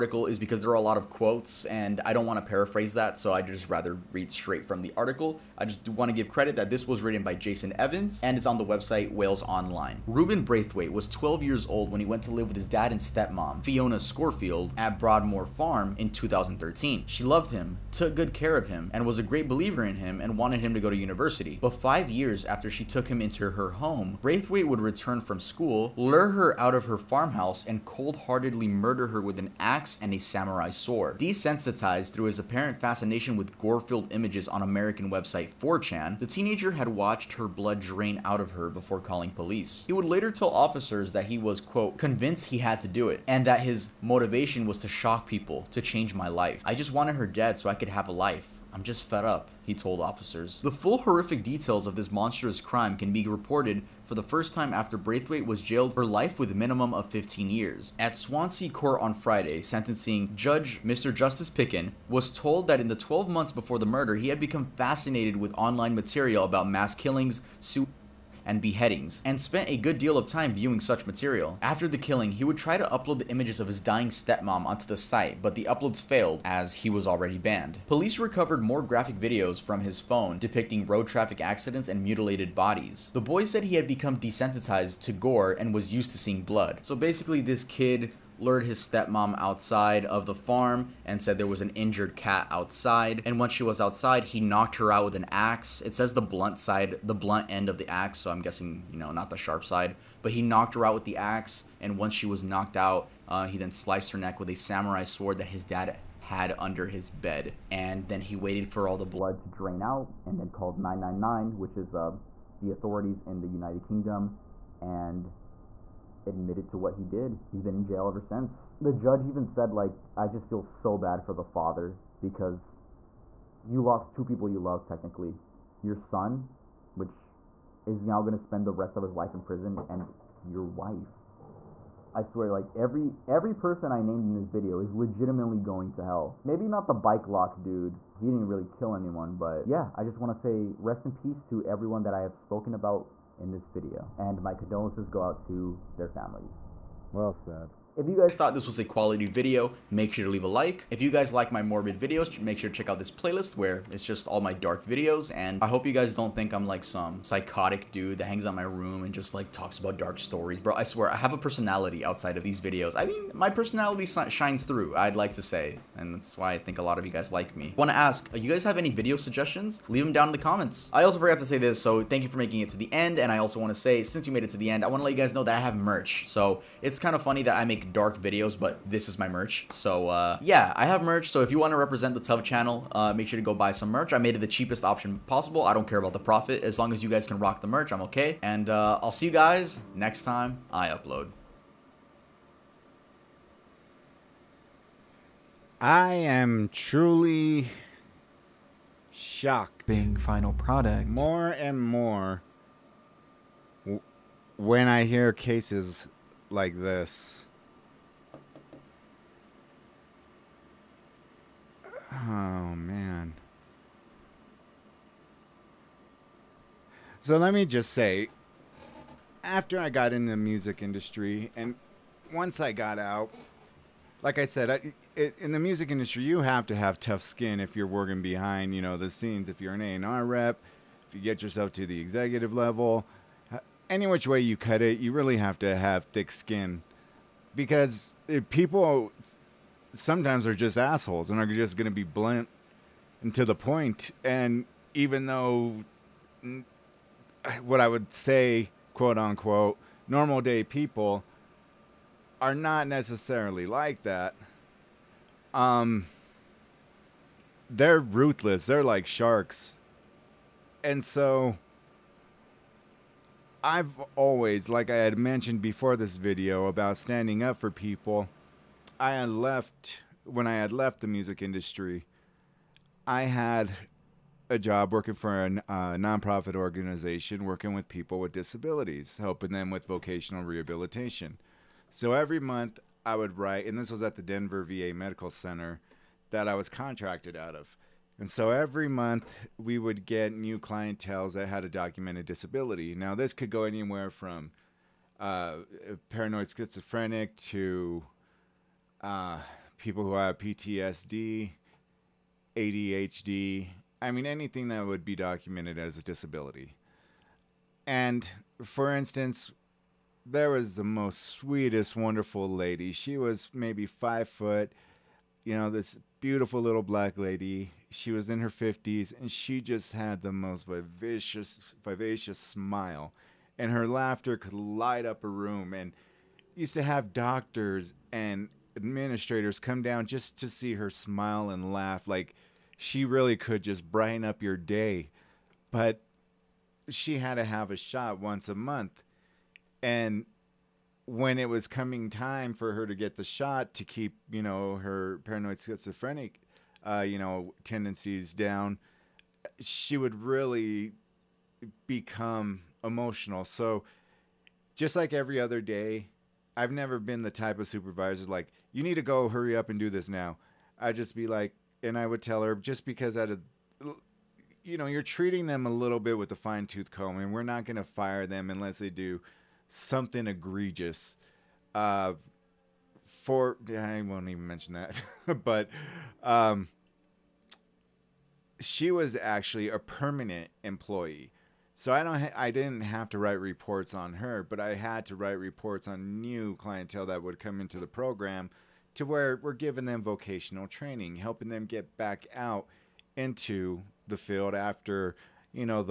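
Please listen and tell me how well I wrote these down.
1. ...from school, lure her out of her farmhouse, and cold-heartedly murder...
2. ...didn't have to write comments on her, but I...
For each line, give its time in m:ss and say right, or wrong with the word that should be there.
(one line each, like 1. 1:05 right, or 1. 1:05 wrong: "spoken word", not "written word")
1. 0:25 right
2. 6:22 wrong: "reports", not "comments".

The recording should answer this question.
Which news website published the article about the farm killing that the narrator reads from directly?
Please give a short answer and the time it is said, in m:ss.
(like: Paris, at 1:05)
Wales Online, at 0:09.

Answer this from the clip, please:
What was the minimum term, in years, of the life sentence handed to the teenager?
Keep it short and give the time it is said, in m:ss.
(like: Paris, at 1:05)
15 years, at 0:57.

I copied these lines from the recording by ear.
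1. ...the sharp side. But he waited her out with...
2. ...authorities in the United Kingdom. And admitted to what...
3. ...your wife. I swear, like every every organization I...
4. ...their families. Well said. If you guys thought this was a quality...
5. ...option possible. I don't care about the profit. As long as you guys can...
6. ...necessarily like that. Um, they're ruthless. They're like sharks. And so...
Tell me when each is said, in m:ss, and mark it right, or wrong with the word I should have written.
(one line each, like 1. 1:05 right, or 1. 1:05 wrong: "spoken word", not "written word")
1. 1:39 wrong: "knocked", not "waited"
2. 1:52 right
3. 2:10 wrong: "person", not "organization"
4. 2:25 right
5. 3:04 right
6. 4:12 right.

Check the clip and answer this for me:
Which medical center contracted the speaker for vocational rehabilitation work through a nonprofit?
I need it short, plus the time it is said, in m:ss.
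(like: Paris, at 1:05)
Denver VA Medical Center, at 4:44.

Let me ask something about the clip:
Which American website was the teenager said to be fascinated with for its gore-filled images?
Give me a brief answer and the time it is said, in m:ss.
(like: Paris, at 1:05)
4chan, at 0:35.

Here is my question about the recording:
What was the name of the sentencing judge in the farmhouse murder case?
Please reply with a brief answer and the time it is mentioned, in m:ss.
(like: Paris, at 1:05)
Mr. Justice Picken, at 1:00.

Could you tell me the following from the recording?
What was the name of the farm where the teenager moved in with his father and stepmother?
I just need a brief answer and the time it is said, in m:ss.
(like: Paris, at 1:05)
Broadmoor Farm, at 0:14.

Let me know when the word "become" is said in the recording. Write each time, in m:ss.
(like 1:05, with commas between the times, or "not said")
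1:04, 1:23, 5:51.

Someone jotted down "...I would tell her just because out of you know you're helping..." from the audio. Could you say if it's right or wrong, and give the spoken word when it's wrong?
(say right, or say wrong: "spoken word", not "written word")
wrong: "treating", not "helping".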